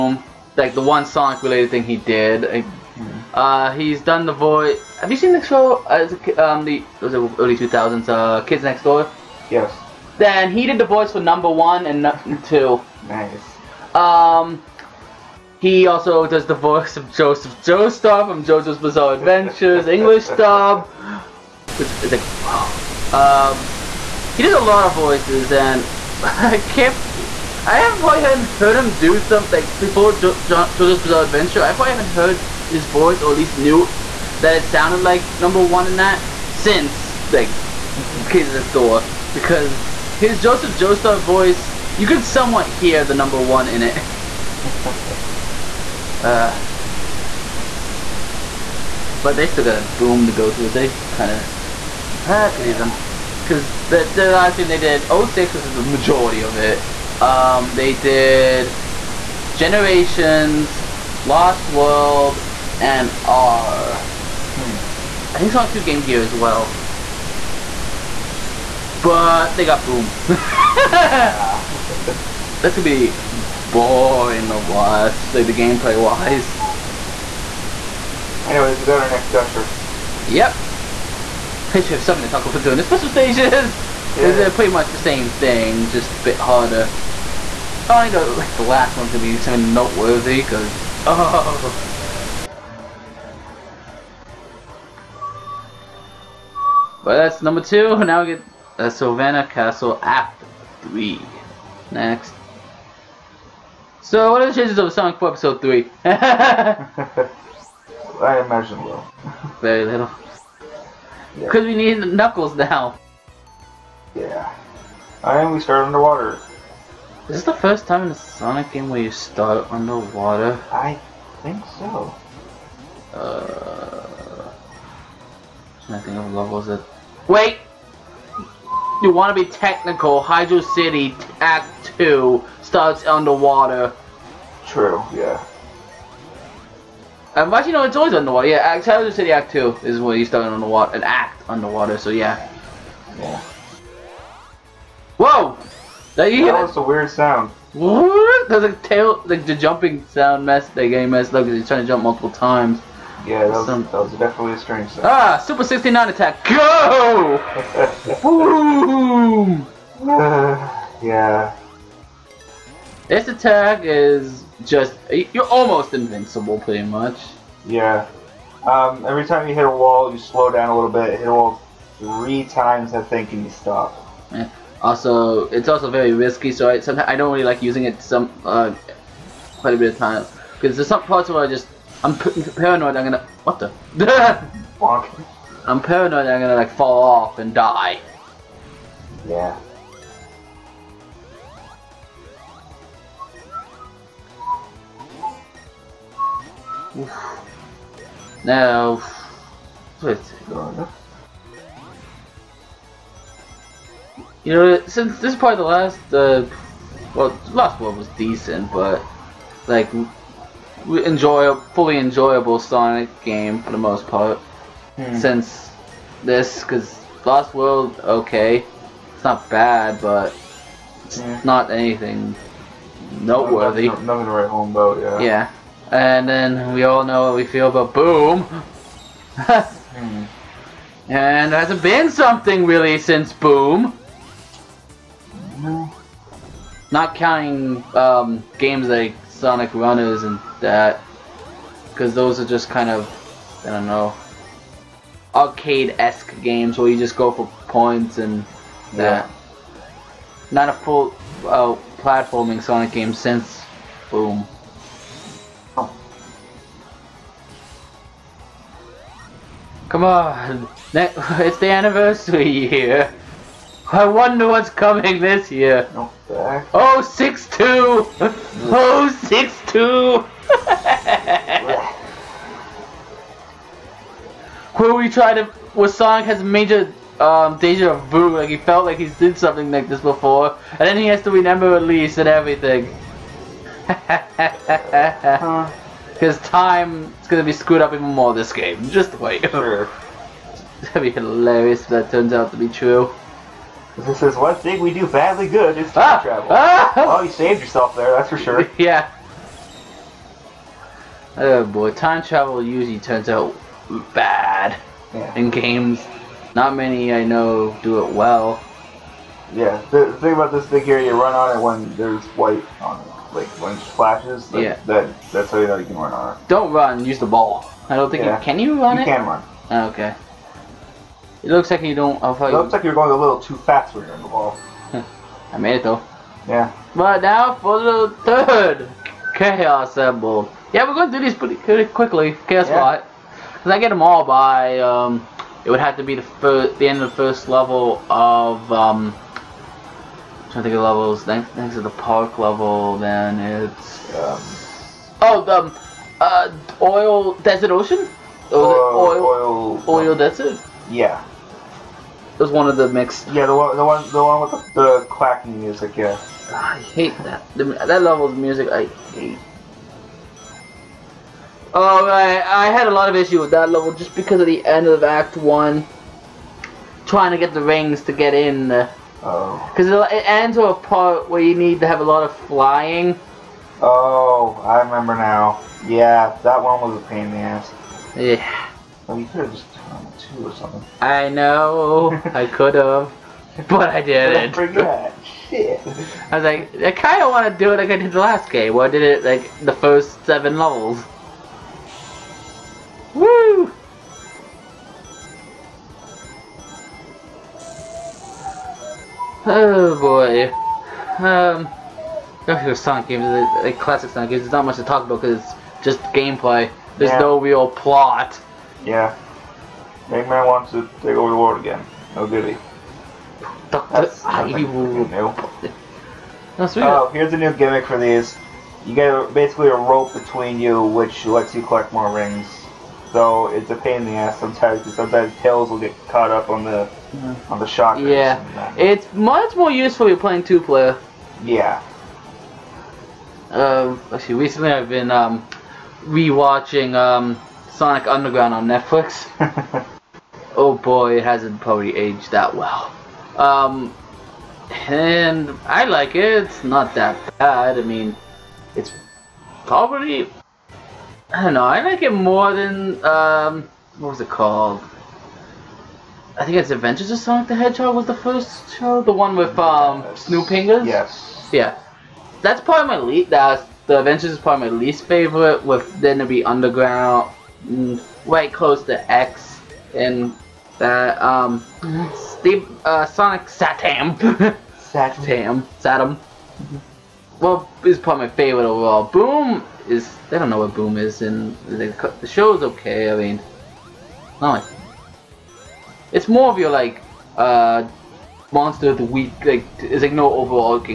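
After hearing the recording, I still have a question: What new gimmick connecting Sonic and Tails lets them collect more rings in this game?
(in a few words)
a rope.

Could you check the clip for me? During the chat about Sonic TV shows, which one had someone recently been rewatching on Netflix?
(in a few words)
Sonic Underground.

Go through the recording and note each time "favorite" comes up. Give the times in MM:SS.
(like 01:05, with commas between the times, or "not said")
07:45, 07:58.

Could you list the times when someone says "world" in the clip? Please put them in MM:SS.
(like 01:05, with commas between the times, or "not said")
01:01, 03:37, 06:51.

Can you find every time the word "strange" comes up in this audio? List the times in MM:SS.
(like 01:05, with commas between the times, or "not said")
02:34.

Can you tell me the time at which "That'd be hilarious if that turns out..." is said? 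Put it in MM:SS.
04:50.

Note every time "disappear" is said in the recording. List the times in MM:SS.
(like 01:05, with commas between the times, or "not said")
not said.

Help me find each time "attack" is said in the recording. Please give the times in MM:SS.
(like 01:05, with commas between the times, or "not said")
02:36, 02:43.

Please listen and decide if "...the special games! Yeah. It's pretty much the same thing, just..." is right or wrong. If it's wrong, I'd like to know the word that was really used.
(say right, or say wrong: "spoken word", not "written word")
wrong: "stages", not "games".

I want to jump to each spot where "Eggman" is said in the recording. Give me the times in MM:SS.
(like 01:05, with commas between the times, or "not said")
06:50.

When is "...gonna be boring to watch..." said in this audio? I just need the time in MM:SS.
01:12.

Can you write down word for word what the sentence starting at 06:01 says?
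Oh, I I had a lot of issue with that level just because of the end of Act 1.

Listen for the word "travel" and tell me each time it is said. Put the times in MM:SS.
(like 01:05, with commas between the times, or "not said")
04:56, 05:02.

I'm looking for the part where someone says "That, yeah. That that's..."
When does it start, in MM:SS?
05:14.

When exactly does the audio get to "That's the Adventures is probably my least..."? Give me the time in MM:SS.
07:43.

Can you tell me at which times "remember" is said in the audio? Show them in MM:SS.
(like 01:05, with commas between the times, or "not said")
04:41, 06:14.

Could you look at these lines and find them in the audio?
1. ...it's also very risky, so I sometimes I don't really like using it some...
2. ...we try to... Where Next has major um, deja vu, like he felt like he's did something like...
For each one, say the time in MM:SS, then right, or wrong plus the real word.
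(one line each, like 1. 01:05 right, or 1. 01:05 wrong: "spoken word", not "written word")
1. 02:55 right
2. 04:34 wrong: "Sonic", not "Next".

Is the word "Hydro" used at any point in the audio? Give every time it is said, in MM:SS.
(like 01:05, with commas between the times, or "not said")
02:10, 02:18.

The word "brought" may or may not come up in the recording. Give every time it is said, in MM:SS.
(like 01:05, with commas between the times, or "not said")
not said.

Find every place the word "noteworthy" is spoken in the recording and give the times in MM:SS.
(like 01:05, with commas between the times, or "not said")
01:29, 03:43.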